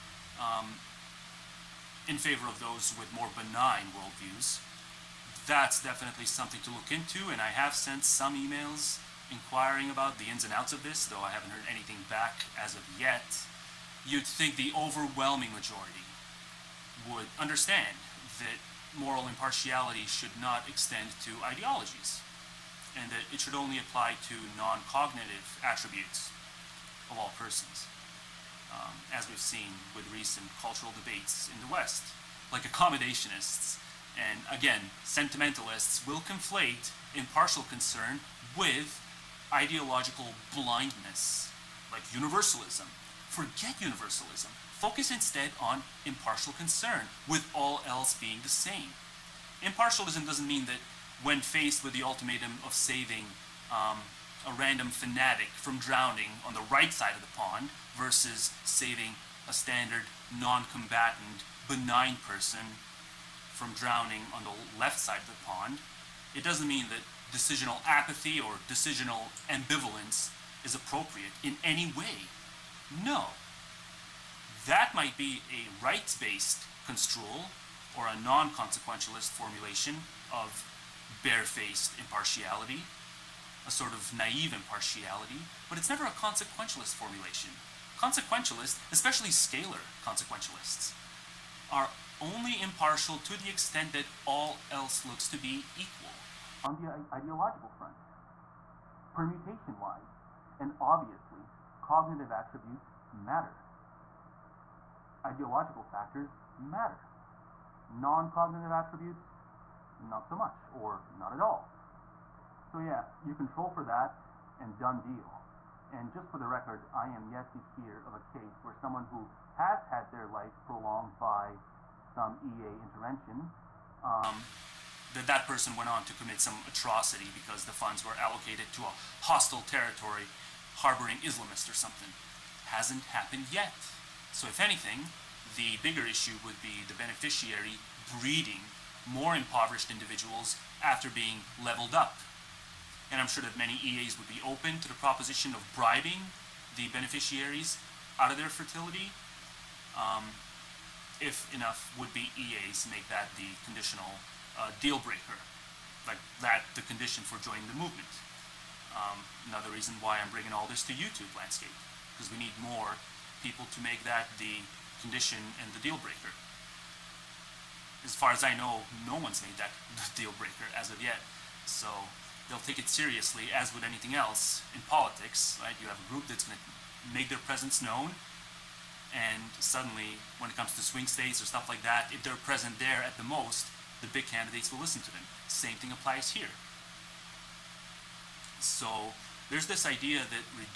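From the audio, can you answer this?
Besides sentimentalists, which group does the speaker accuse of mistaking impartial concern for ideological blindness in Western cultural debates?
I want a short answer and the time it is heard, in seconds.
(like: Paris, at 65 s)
accommodationists, at 32 s.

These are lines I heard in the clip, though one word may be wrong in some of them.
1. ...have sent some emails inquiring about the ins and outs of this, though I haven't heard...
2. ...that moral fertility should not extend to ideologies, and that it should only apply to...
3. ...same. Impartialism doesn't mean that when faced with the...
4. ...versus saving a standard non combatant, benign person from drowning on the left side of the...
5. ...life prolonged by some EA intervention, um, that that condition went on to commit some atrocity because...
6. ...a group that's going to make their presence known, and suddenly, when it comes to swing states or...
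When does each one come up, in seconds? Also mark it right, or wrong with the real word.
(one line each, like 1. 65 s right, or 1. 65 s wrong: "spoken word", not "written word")
1. 7 s right
2. 18 s wrong: "impartiality", not "fertility"
3. 48 s right
4. 57 s right
5. 120 s wrong: "person", not "condition"
6. 175 s right.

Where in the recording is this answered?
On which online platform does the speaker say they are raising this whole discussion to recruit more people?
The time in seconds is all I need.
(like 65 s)
160 s.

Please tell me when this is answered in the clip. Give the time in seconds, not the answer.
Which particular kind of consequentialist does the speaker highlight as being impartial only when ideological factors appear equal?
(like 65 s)
89 s.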